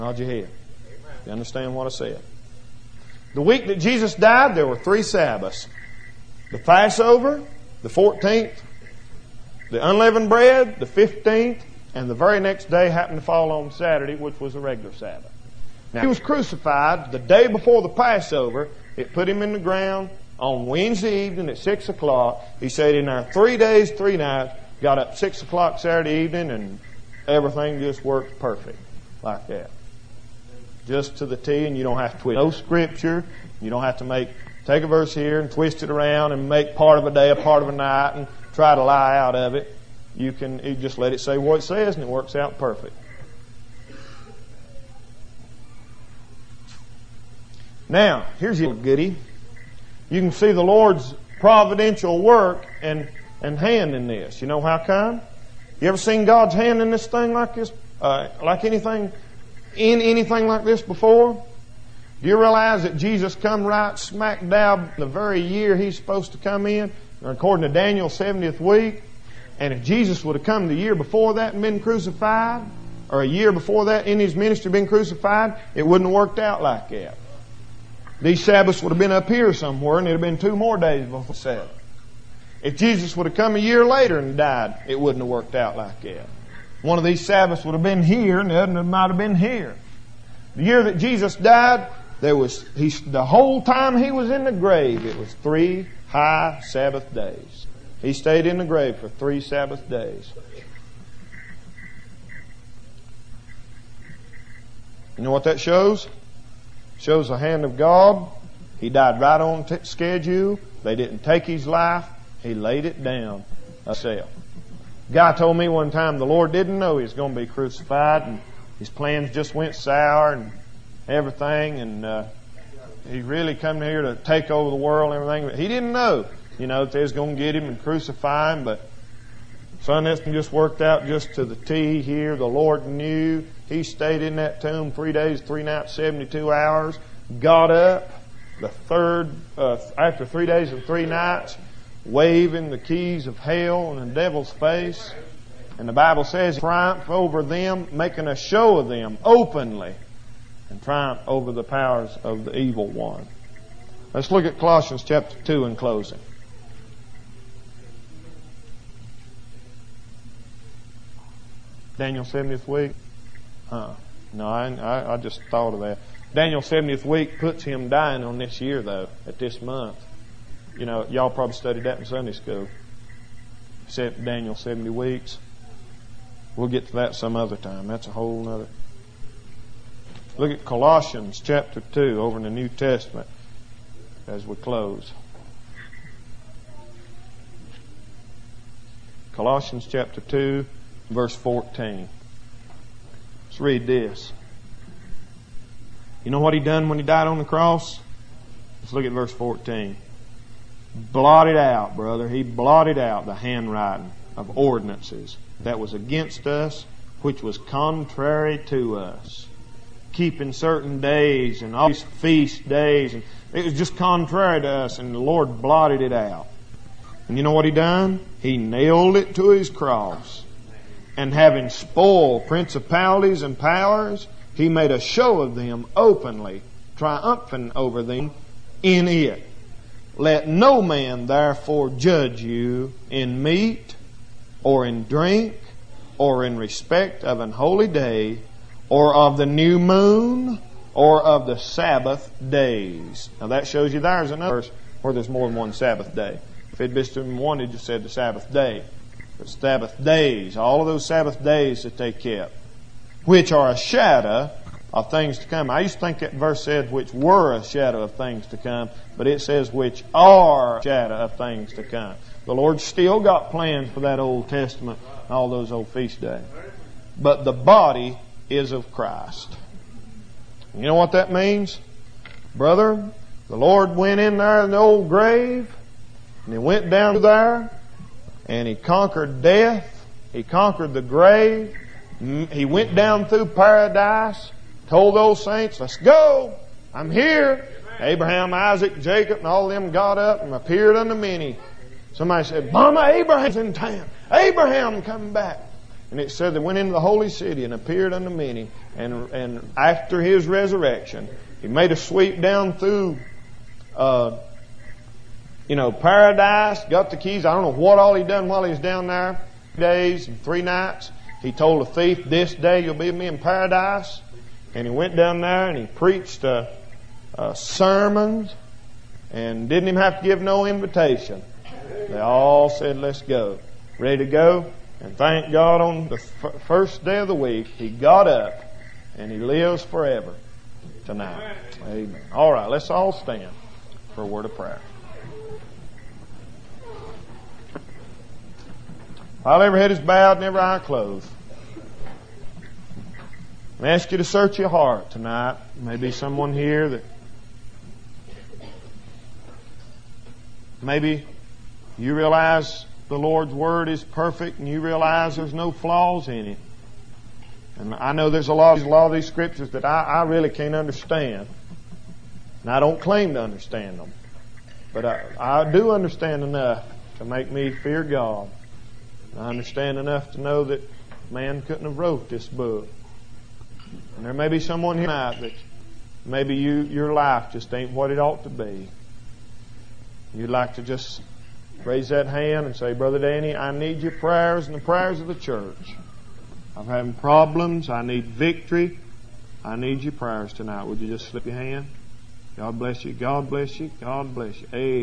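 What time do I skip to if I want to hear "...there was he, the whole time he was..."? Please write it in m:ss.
1:32.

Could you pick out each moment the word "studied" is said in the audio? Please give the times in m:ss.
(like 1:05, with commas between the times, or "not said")
2:51.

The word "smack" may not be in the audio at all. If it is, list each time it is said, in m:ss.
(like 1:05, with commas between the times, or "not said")
1:03.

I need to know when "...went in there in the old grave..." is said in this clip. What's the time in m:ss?
4:33.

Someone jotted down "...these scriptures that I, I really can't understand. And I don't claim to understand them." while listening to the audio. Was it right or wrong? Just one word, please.
right.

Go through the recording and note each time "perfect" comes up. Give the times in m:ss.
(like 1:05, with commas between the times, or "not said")
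0:28, 0:42, 5:54.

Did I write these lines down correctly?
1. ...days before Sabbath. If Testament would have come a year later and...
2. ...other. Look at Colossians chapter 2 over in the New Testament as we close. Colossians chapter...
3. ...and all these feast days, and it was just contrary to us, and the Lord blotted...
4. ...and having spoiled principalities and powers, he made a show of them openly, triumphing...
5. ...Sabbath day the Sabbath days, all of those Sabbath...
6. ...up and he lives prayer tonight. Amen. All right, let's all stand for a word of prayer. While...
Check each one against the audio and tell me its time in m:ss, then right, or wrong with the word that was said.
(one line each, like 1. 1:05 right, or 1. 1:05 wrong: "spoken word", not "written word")
1. 1:20 wrong: "Jesus", not "Testament"
2. 2:58 right
3. 3:31 right
4. 3:41 right
5. 4:08 right
6. 5:28 wrong: "forever", not "prayer".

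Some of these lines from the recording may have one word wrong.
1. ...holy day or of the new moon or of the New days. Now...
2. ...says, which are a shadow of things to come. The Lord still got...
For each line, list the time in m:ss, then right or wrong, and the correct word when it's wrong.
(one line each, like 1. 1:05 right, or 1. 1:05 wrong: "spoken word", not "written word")
1. 3:57 wrong: "Sabbath", not "New"
2. 4:19 right.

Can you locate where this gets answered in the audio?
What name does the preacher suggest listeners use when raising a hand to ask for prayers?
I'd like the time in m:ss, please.
6:22.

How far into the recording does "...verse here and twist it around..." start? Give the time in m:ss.
0:34.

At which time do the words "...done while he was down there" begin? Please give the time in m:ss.
5:08.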